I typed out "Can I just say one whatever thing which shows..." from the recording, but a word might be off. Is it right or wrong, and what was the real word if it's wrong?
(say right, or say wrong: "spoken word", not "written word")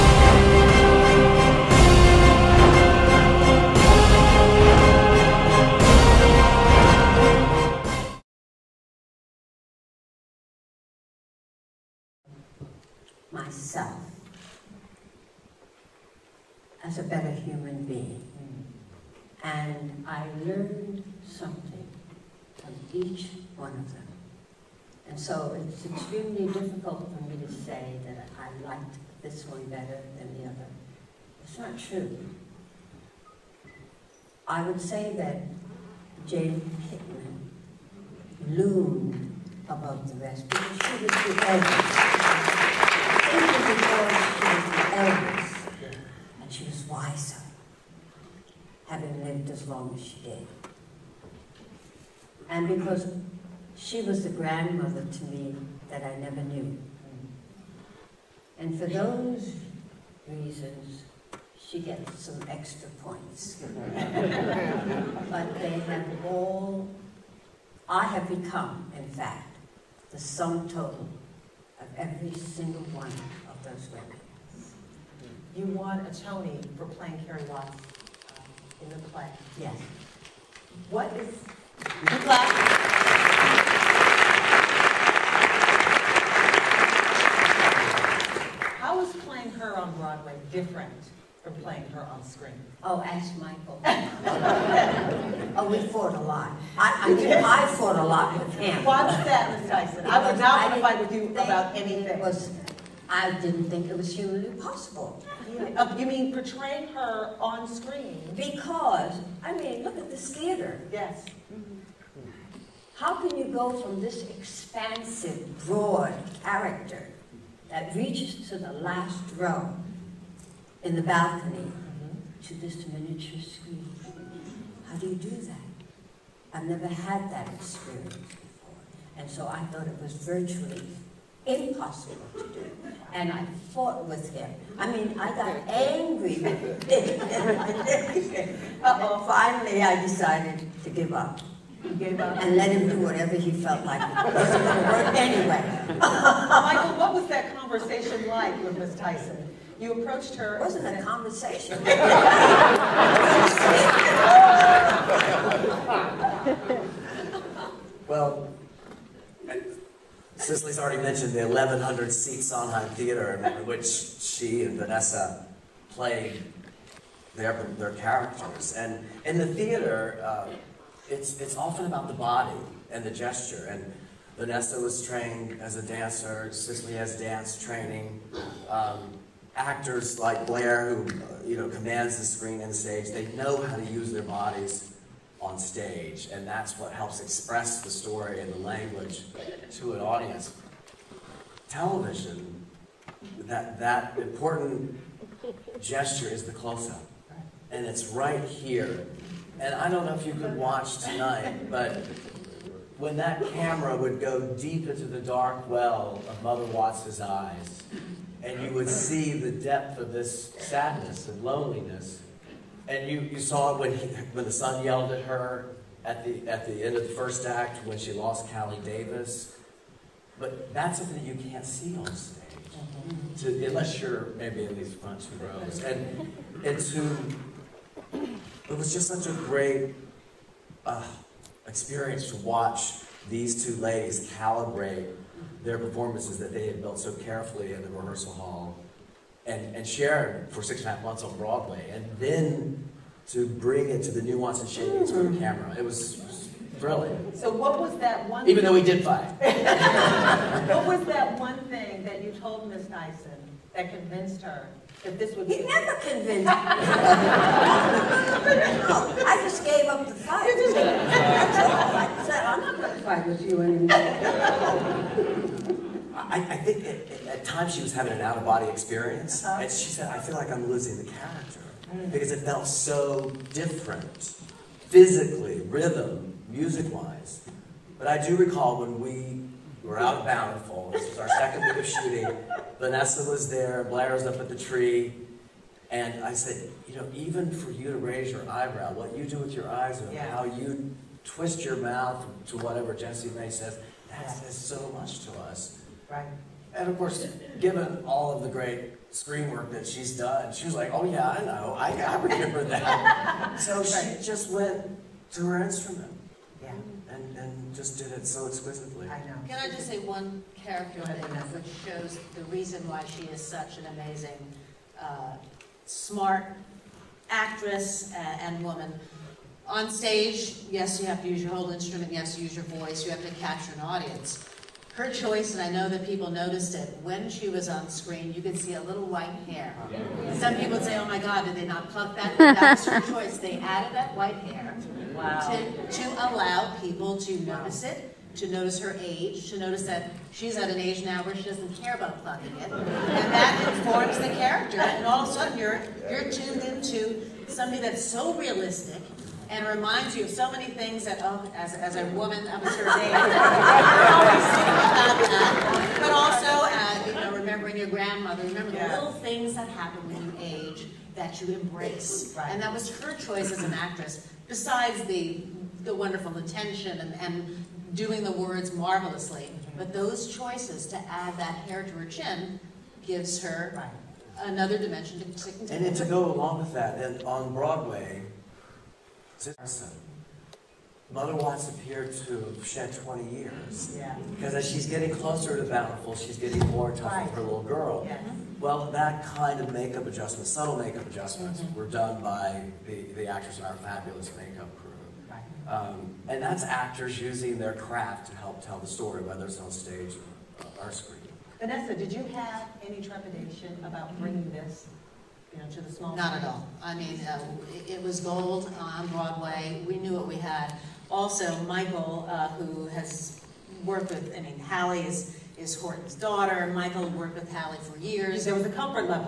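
wrong: "character", not "whatever".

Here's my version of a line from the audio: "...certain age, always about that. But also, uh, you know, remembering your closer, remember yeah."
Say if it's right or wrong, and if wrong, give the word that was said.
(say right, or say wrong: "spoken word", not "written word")
wrong: "grandmother", not "closer".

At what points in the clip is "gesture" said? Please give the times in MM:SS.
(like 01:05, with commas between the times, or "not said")
02:53, 03:15.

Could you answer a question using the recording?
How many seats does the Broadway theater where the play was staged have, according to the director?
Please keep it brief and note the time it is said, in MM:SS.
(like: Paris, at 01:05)
1,100, at 02:41.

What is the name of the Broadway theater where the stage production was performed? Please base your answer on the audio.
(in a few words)
Sondheim Theater.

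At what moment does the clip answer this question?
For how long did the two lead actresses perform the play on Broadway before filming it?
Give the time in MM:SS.
04:00.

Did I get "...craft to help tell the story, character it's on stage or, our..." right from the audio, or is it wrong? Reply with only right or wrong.
wrong.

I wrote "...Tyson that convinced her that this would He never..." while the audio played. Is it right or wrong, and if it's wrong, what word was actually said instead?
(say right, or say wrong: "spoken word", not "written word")
right.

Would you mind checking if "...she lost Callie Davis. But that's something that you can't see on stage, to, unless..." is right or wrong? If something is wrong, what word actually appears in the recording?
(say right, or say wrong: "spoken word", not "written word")
right.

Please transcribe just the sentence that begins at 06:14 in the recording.
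another dimension to, to And to go along with that, and on Broadway, this mother Mother to appeared to shed 20 years.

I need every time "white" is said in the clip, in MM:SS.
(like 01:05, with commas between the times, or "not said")
05:29, 05:34.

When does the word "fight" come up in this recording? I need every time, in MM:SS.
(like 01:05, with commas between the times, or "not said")
01:40, 04:09.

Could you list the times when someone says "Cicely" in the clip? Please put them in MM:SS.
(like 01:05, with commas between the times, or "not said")
02:40, 02:56.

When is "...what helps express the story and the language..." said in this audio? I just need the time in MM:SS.
03:06.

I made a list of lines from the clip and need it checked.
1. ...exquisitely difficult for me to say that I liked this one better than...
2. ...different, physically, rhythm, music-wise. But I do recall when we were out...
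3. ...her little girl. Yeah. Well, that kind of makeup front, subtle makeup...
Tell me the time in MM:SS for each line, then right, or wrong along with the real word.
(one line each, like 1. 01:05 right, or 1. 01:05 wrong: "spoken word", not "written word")
1. 00:25 wrong: "extremely", not "exquisitely"
2. 04:33 right
3. 06:27 wrong: "adjustment", not "front".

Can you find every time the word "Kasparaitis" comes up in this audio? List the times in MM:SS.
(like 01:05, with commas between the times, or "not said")
not said.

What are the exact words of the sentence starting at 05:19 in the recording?
On stage, yes, you have to use your whole instrument, yes, you use your voice, you have to capture an audience.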